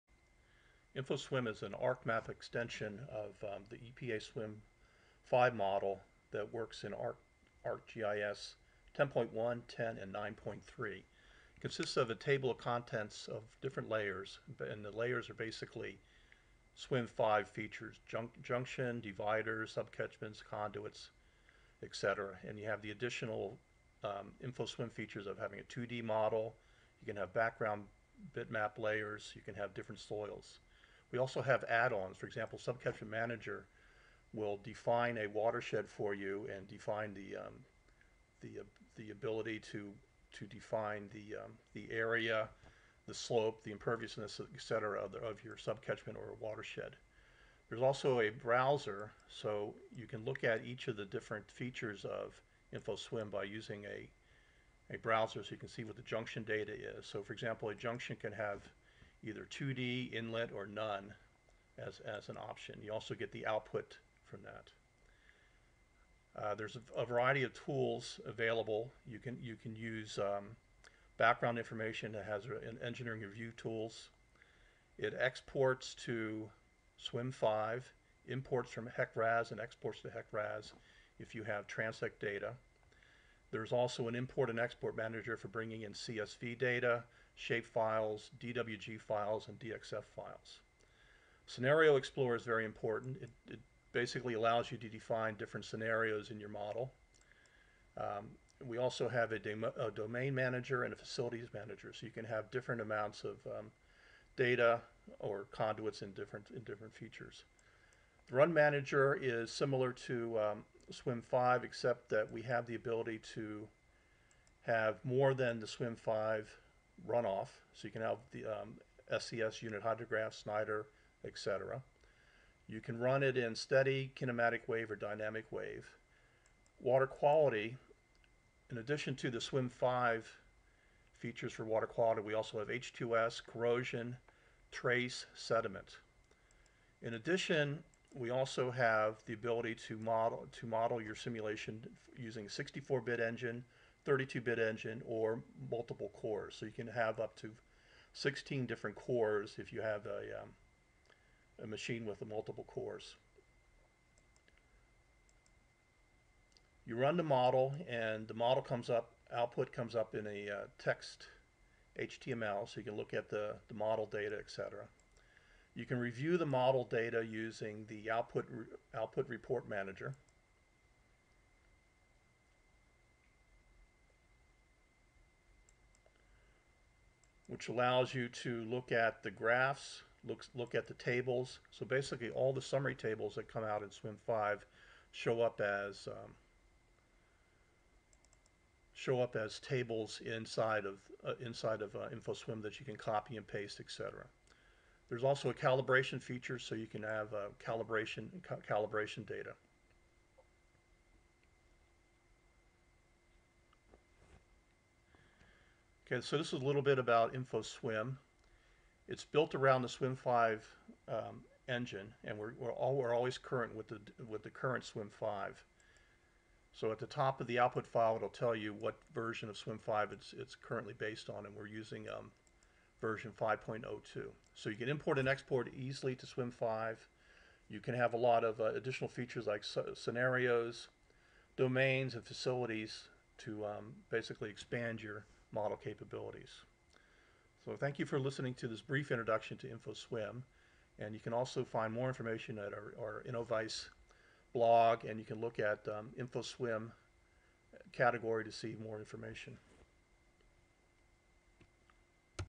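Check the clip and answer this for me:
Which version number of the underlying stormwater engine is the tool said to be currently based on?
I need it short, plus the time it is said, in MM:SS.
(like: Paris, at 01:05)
5.02, at 03:42.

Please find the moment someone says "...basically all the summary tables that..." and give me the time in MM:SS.
03:01.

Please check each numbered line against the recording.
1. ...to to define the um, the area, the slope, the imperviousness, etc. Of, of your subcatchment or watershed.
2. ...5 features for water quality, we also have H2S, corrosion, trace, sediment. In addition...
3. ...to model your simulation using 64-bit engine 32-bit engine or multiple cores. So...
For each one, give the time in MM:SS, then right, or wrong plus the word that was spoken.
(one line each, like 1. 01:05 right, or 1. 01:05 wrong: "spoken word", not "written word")
1. 00:39 right
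2. 02:09 right
3. 02:20 right.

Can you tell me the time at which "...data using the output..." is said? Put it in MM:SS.
02:46.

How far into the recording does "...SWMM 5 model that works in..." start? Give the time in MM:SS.
00:04.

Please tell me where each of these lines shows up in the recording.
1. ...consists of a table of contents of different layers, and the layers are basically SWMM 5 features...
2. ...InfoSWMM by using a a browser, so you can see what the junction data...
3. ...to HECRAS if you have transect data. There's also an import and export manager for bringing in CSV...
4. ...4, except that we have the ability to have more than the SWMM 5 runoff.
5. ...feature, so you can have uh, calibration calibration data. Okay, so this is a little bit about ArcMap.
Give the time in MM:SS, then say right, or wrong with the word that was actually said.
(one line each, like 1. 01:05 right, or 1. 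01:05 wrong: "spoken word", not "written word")
1. 00:11 right
2. 00:52 right
3. 01:20 right
4. 01:51 wrong: "5", not "4"
5. 03:16 wrong: "InfoSWMM", not "ArcMap".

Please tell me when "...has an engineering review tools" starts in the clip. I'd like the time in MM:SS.
01:12.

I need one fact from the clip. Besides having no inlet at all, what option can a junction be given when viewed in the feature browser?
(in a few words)
2D inlet.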